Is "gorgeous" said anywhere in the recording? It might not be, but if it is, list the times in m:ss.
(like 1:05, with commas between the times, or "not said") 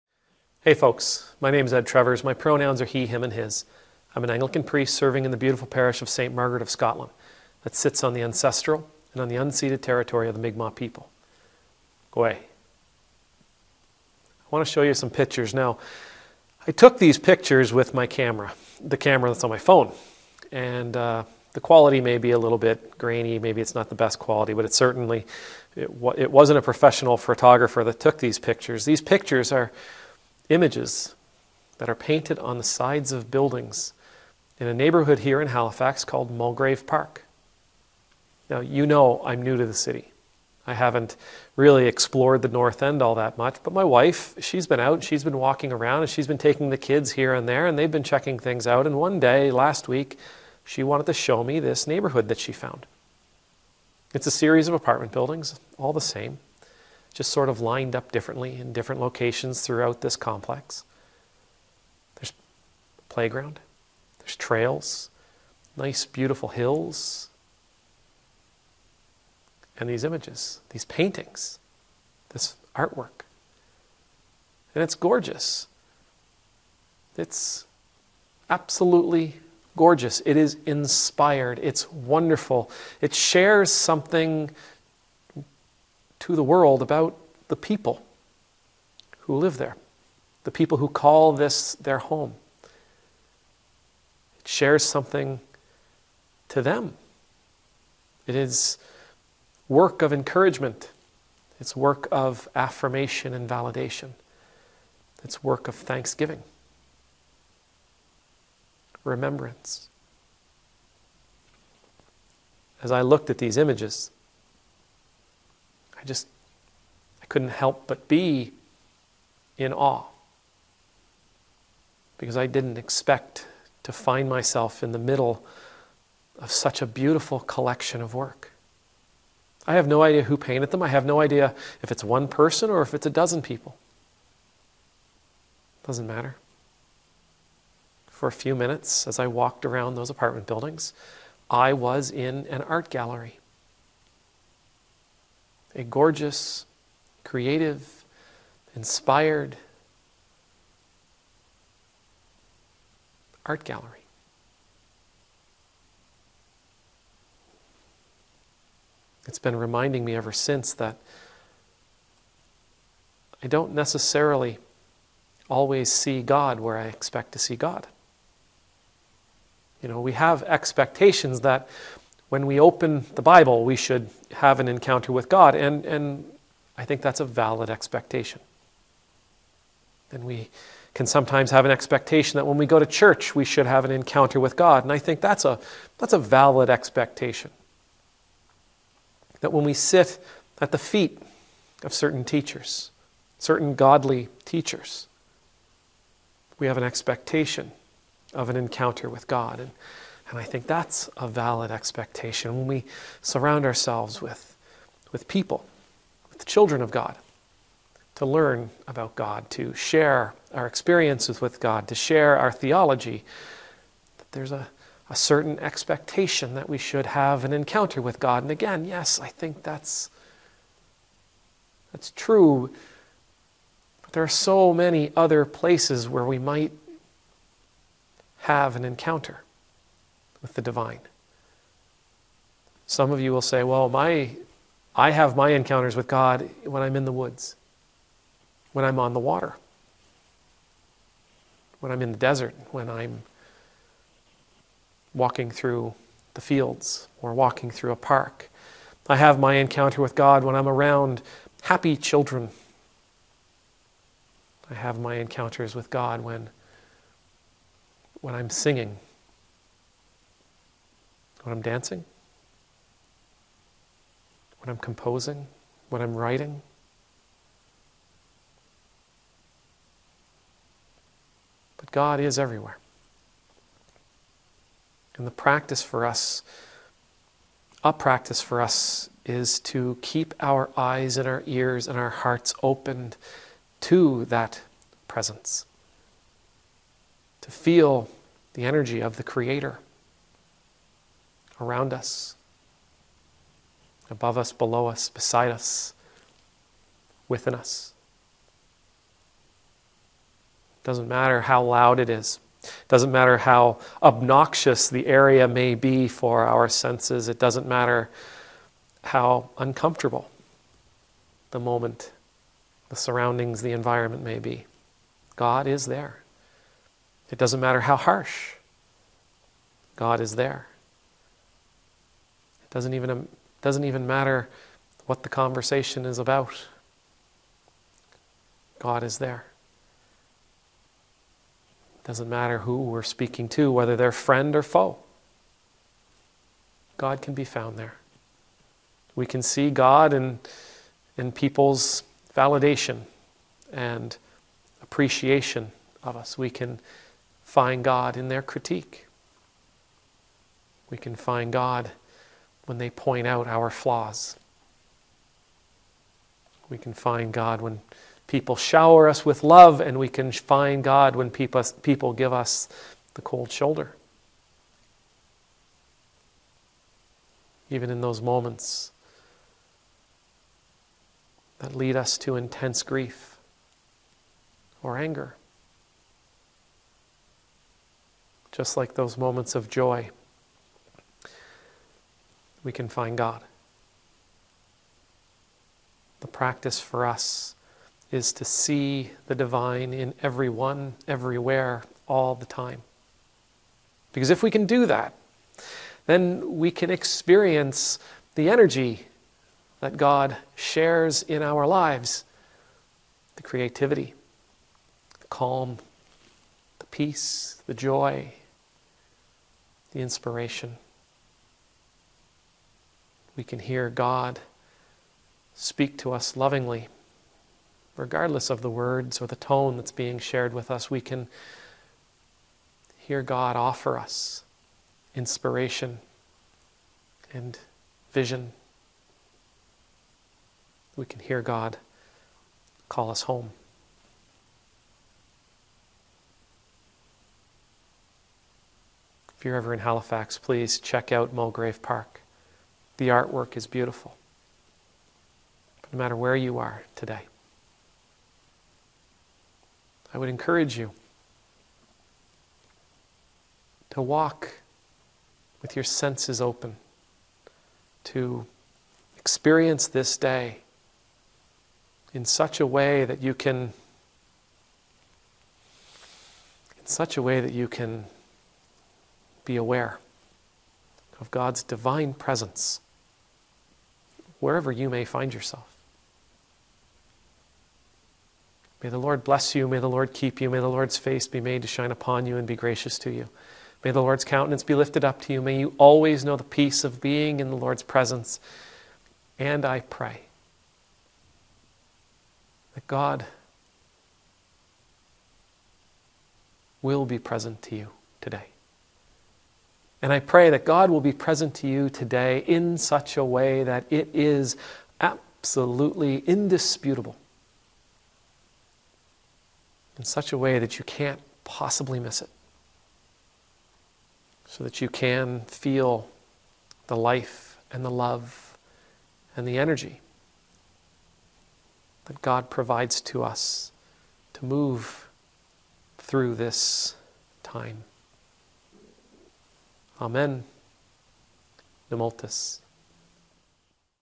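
1:14, 1:19, 2:25.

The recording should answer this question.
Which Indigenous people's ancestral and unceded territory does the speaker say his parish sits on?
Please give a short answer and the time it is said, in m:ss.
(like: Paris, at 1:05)
Mi'kmaq, at 0:10.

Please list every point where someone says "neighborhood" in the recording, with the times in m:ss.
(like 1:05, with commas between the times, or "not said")
0:34, 0:51.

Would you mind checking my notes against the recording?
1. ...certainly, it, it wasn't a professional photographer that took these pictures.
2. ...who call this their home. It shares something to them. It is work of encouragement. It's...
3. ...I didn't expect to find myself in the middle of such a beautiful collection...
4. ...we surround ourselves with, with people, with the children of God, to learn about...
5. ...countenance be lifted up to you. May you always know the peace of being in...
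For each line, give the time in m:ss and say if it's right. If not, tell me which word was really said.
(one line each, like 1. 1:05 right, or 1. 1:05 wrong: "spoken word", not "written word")
1. 0:24 right
2. 1:30 right
3. 2:02 right
4. 3:22 right
5. 8:04 right.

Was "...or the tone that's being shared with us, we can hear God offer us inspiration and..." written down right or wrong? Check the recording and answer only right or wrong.
right.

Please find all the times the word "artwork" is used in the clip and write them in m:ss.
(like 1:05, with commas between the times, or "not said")
1:12, 7:23.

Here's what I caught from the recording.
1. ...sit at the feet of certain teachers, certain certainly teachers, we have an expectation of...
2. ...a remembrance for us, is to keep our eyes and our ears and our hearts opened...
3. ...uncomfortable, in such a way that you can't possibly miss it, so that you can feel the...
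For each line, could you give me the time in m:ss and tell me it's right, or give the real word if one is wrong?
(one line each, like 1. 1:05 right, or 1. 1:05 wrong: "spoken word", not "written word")
1. 3:09 wrong: "godly", not "certainly"
2. 4:37 wrong: "practice", not "remembrance"
3. 8:26 wrong: "indisputable", not "uncomfortable".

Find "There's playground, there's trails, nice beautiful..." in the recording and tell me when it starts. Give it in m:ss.
1:02.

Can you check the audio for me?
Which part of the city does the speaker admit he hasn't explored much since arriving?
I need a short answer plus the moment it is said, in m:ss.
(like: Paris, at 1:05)
The North End, at 0:42.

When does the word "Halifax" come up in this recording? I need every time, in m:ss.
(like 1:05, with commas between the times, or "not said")
0:35, 7:19.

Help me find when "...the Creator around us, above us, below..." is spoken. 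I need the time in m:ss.
4:49.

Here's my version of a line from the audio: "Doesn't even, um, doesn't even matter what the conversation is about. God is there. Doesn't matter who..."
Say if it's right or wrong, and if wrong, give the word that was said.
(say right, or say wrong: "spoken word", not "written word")
right.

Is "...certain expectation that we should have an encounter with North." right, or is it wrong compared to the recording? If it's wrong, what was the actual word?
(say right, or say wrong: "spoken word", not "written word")
wrong: "God", not "North".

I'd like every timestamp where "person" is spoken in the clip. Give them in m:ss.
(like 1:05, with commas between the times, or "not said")
2:12.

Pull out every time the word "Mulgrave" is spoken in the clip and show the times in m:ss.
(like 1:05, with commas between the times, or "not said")
0:36, 7:21.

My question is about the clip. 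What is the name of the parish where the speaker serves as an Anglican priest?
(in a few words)
St. Margaret of Scotland.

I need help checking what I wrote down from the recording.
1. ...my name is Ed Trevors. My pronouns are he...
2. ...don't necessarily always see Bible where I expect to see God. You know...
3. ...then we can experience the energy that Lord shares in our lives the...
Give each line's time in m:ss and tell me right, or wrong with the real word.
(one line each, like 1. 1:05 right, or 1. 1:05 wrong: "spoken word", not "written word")
1. 0:01 right
2. 2:43 wrong: "God", not "Bible"
3. 6:36 wrong: "God", not "Lord".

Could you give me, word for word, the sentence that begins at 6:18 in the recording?
Just like those moments of joy we can find God.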